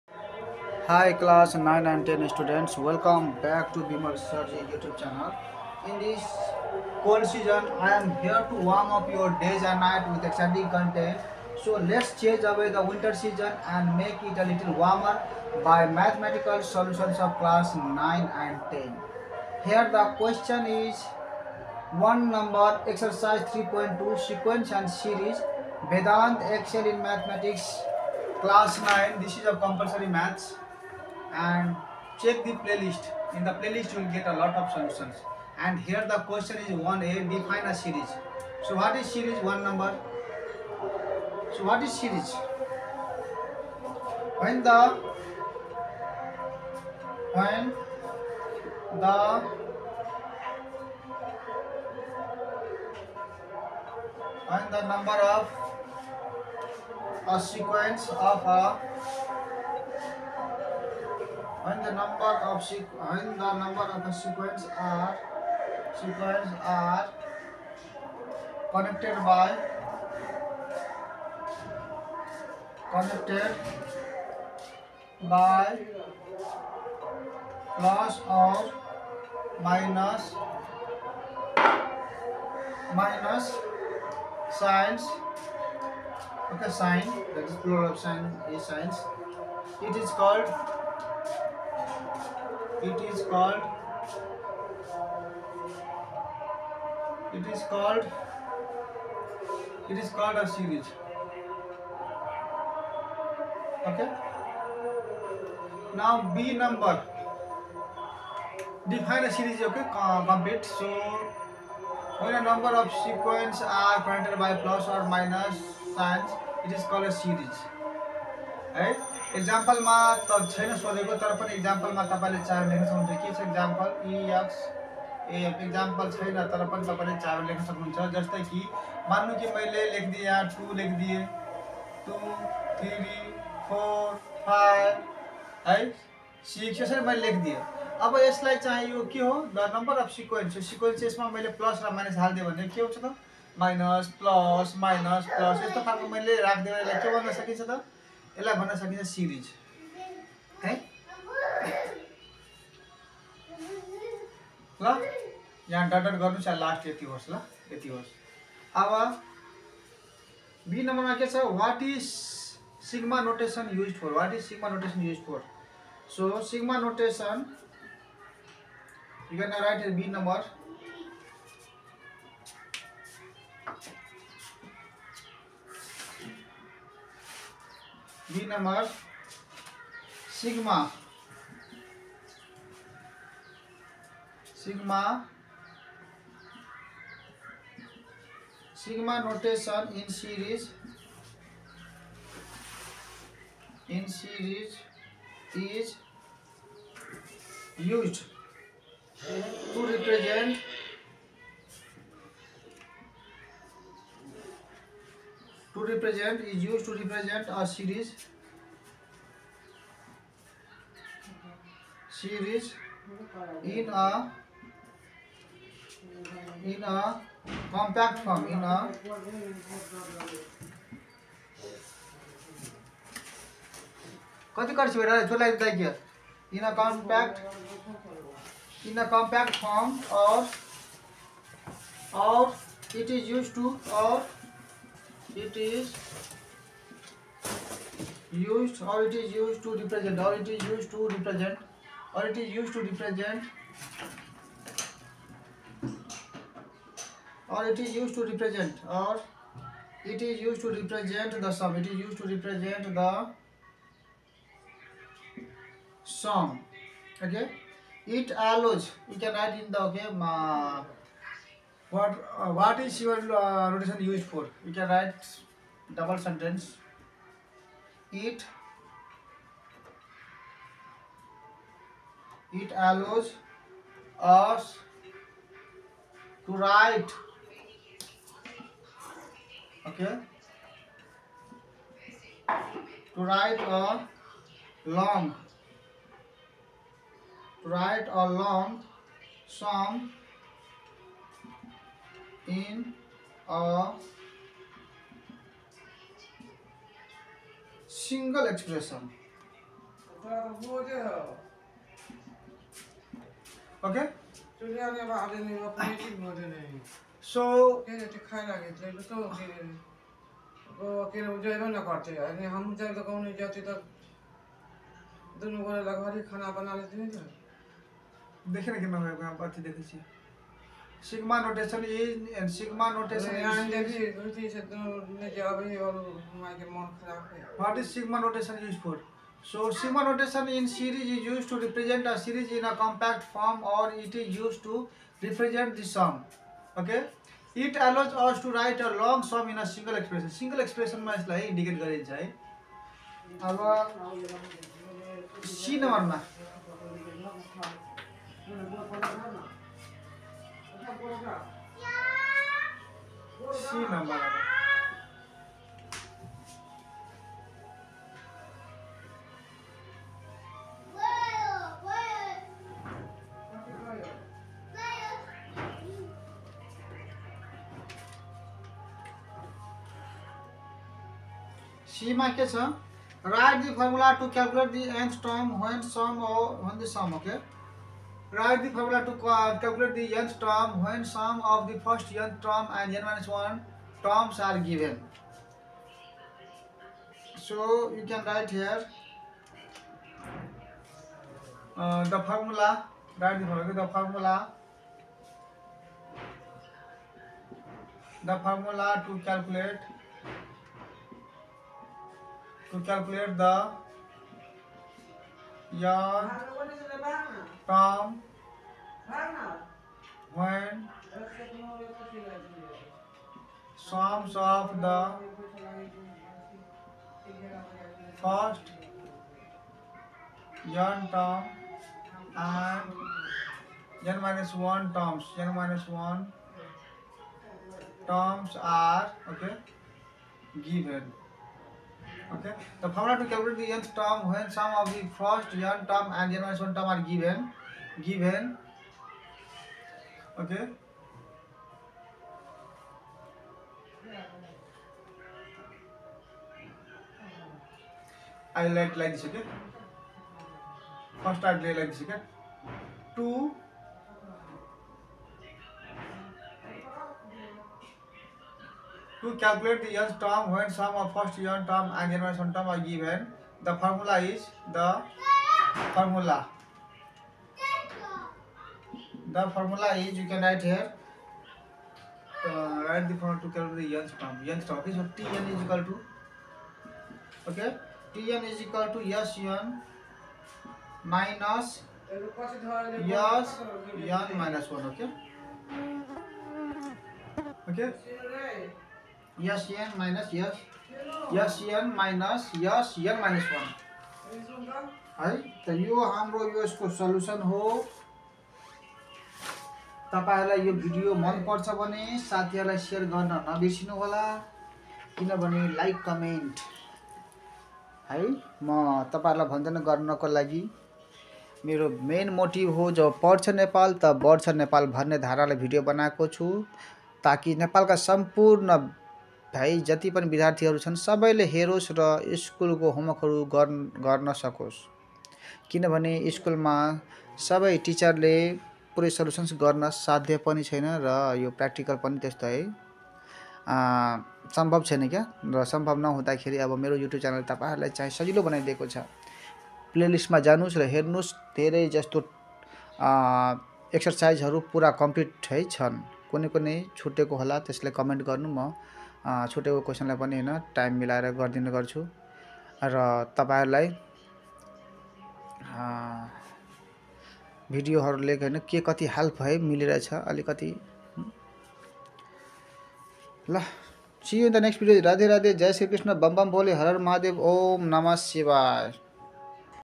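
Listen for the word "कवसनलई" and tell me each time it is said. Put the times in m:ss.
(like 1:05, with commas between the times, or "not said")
9:09.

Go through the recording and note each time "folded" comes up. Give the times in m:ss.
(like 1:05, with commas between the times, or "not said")
not said.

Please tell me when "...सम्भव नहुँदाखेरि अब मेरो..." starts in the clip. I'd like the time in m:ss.
8:55.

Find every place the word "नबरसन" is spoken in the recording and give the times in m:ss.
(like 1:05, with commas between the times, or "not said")
8:23.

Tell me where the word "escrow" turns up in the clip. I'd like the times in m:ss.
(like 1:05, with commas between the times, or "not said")
not said.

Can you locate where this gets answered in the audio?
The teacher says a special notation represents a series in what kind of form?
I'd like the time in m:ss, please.
3:37.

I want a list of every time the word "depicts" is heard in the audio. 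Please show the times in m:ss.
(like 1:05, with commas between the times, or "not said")
not said.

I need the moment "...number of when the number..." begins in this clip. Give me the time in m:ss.
1:01.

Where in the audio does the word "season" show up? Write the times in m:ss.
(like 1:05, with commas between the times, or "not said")
0:07, 0:13.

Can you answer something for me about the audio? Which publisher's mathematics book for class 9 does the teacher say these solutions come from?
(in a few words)
Vedanta Excel.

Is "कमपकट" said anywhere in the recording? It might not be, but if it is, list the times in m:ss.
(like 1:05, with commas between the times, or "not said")
5:32.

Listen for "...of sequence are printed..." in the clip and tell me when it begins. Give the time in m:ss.
1:52.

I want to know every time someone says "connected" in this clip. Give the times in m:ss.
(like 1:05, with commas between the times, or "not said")
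1:08, 1:12.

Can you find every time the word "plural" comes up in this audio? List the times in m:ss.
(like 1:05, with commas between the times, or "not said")
1:27.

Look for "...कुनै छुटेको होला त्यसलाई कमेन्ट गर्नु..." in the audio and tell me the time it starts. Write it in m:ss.
9:06.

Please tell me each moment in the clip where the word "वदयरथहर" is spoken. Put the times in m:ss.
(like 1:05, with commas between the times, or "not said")
8:40.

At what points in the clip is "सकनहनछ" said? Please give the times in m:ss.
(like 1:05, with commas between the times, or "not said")
2:02, 2:07.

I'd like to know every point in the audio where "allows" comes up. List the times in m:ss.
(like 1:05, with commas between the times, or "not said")
4:18, 4:32.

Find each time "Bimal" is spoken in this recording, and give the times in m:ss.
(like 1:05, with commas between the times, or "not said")
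0:03.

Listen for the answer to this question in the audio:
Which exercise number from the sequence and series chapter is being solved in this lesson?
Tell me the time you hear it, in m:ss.
0:22.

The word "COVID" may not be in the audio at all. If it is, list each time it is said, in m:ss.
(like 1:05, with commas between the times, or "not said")
not said.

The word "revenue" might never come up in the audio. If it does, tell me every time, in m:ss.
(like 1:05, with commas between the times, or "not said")
not said.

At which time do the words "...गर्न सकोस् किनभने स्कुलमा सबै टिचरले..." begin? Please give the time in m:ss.
8:44.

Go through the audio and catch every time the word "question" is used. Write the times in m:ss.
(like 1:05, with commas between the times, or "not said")
0:20, 0:36.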